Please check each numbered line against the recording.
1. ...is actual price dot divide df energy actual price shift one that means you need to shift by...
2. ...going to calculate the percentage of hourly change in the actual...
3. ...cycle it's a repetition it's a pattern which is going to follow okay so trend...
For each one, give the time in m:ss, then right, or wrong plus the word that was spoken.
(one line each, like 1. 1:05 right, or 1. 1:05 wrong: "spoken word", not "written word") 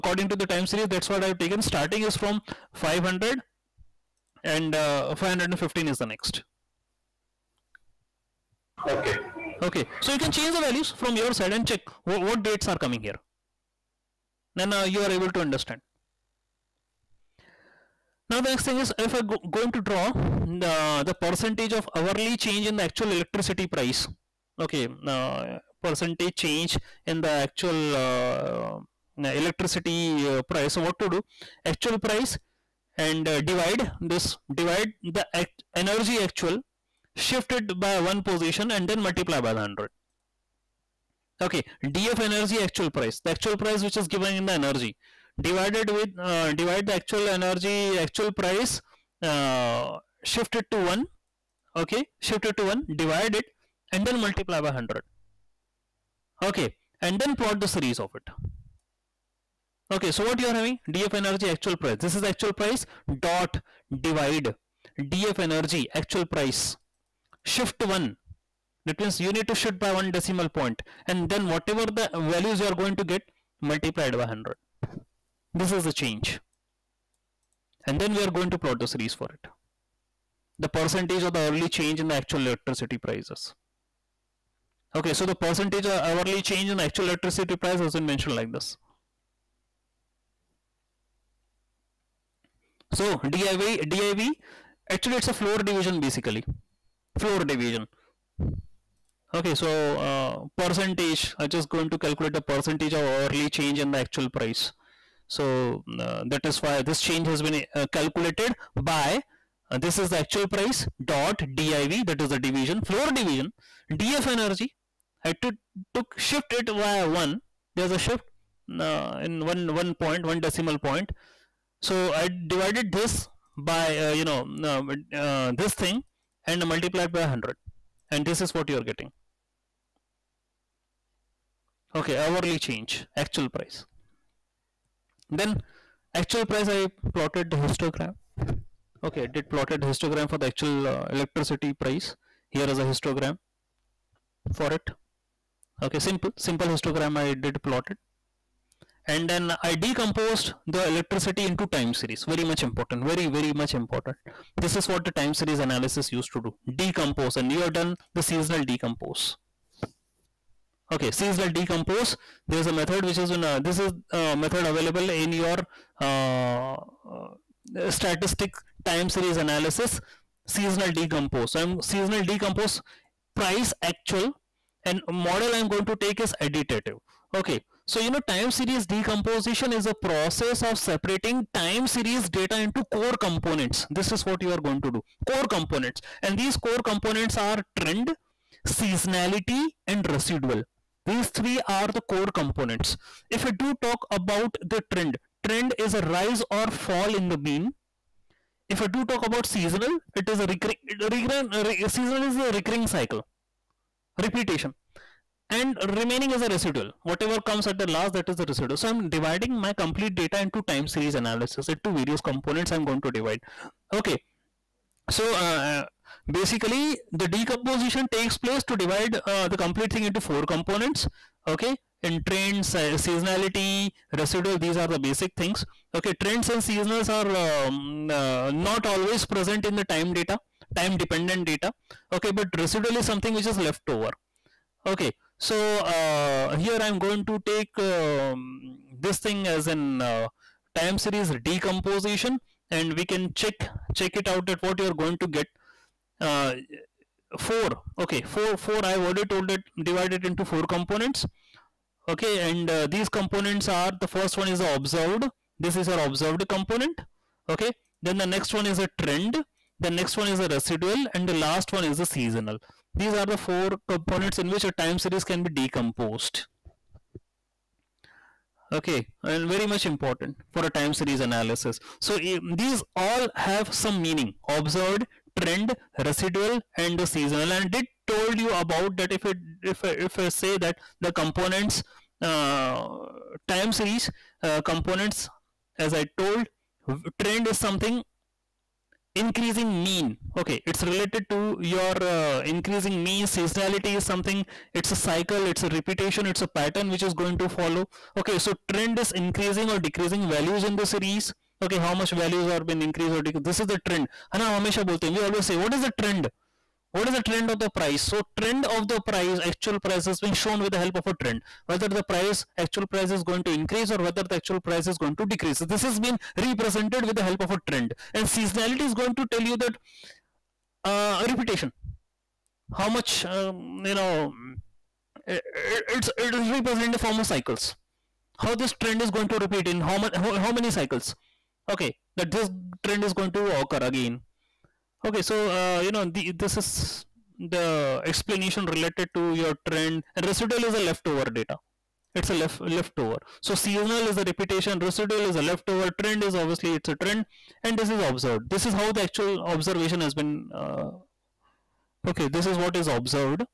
1. 1:02 right
2. 1:41 right
3. 4:54 right.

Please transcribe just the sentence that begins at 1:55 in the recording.
I took, took shift it by one.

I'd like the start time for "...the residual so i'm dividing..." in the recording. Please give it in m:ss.
3:28.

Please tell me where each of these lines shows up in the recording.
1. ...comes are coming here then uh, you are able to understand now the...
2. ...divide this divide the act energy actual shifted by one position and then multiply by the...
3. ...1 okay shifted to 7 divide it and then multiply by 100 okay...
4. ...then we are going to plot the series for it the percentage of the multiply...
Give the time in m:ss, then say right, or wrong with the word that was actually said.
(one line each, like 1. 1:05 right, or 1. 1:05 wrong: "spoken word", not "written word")
1. 0:12 wrong: "dates", not "comes"
2. 0:33 right
3. 0:50 wrong: "1", not "7"
4. 1:17 wrong: "hourly", not "multiply".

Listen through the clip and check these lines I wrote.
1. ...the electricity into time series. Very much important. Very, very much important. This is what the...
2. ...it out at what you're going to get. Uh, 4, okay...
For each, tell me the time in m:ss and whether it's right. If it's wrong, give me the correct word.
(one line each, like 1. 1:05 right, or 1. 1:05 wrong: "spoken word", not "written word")
1. 2:30 right
2. 4:04 right.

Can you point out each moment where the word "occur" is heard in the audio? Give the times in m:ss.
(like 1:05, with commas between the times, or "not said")
5:33.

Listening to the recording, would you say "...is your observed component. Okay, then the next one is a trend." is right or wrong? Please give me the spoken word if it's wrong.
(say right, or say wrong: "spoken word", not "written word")
right.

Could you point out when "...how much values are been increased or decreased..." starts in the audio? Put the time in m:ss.
5:01.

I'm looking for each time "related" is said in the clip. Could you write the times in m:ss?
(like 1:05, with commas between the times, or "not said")
4:50, 5:38.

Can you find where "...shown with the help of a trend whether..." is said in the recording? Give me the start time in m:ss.
5:10.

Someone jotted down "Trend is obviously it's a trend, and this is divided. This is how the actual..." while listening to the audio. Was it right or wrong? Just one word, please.
wrong.